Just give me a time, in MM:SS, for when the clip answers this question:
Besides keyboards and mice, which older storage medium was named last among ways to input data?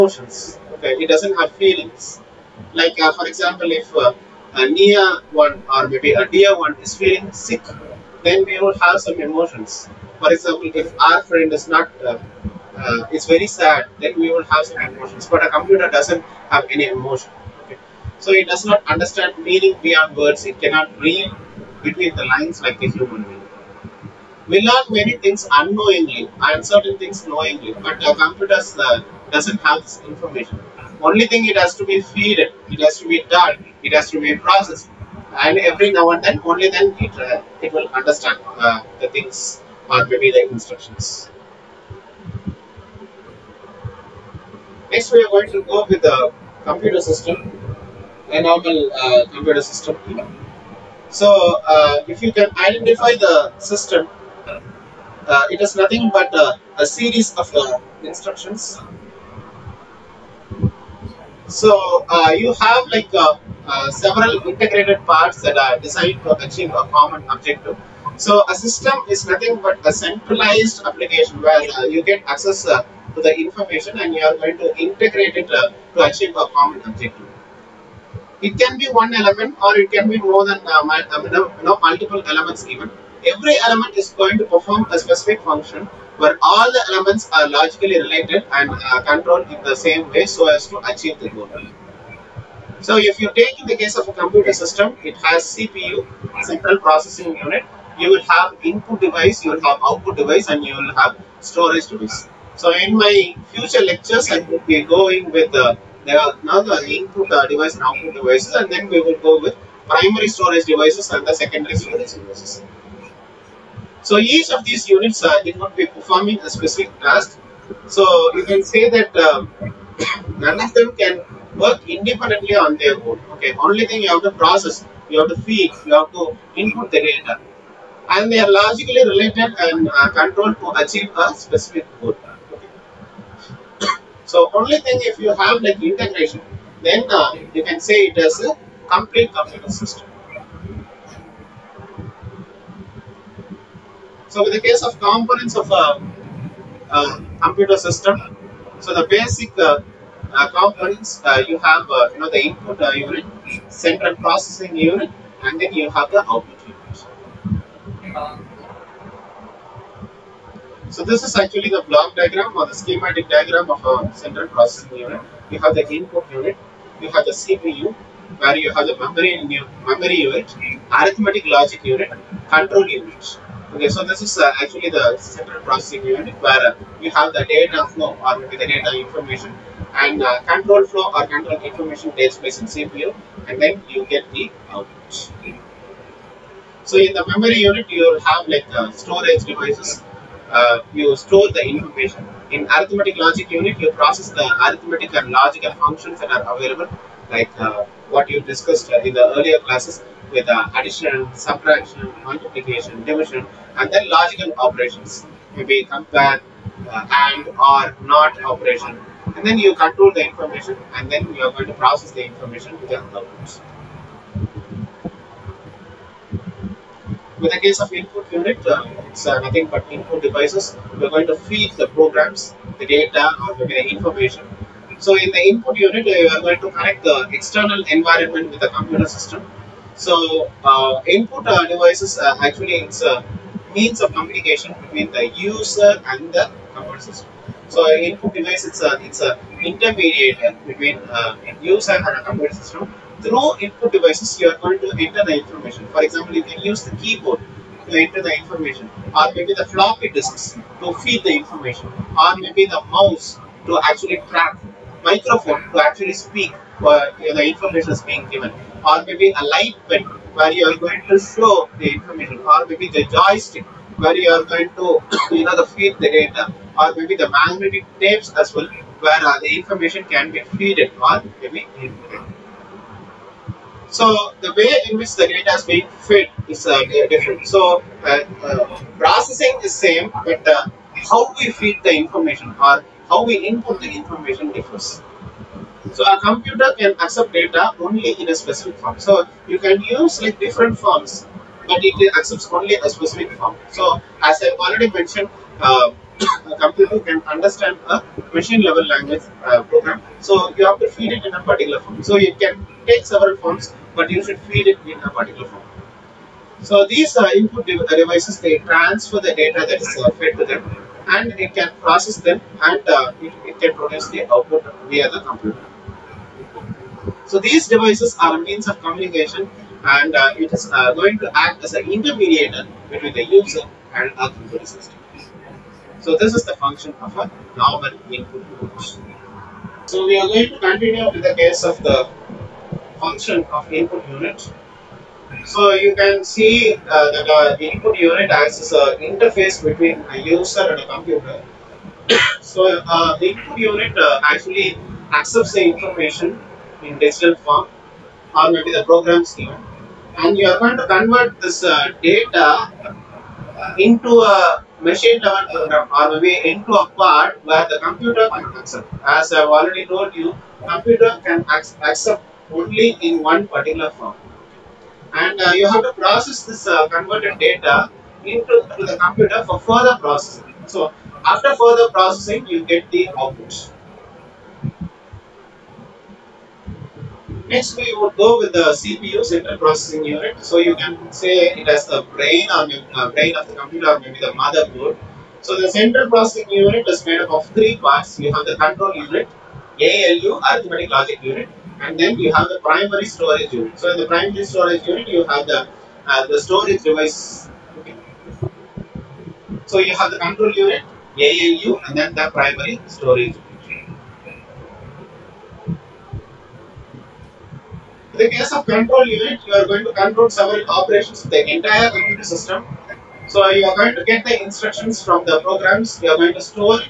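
04:27.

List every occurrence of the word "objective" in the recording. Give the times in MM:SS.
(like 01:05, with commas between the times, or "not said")
01:07, 01:16.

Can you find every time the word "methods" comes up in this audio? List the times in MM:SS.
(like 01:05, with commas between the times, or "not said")
not said.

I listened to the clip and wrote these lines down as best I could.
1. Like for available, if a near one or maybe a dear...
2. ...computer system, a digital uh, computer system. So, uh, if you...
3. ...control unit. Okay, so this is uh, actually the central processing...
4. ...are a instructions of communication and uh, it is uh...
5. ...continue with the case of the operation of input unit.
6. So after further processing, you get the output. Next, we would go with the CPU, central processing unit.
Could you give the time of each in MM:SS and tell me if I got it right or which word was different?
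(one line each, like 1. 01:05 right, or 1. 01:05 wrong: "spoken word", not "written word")
1. 00:02 wrong: "example", not "available"
2. 00:46 wrong: "normal", not "digital"
3. 02:52 right
4. 05:18 wrong: "means", not "instructions"
5. 05:30 wrong: "function", not "operation"
6. 06:10 right.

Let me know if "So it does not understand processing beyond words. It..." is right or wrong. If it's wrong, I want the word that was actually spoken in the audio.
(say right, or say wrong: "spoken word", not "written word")
wrong: "meaning", not "processing".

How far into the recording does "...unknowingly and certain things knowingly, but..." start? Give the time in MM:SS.
00:25.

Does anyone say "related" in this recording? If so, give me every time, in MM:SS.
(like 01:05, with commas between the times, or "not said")
01:28, 02:09.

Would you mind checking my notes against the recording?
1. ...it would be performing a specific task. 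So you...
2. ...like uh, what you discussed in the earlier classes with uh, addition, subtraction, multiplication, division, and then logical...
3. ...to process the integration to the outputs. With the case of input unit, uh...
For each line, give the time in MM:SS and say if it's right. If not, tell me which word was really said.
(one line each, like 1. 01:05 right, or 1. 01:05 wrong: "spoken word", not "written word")
1. 01:55 right
2. 03:17 right
3. 03:31 wrong: "information", not "integration".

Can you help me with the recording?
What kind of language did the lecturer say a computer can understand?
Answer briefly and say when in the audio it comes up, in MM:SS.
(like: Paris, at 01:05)
Machine level language, at 04:58.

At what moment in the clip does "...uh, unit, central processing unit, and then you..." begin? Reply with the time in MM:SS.
02:32.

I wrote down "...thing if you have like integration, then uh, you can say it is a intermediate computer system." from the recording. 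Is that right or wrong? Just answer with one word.
wrong.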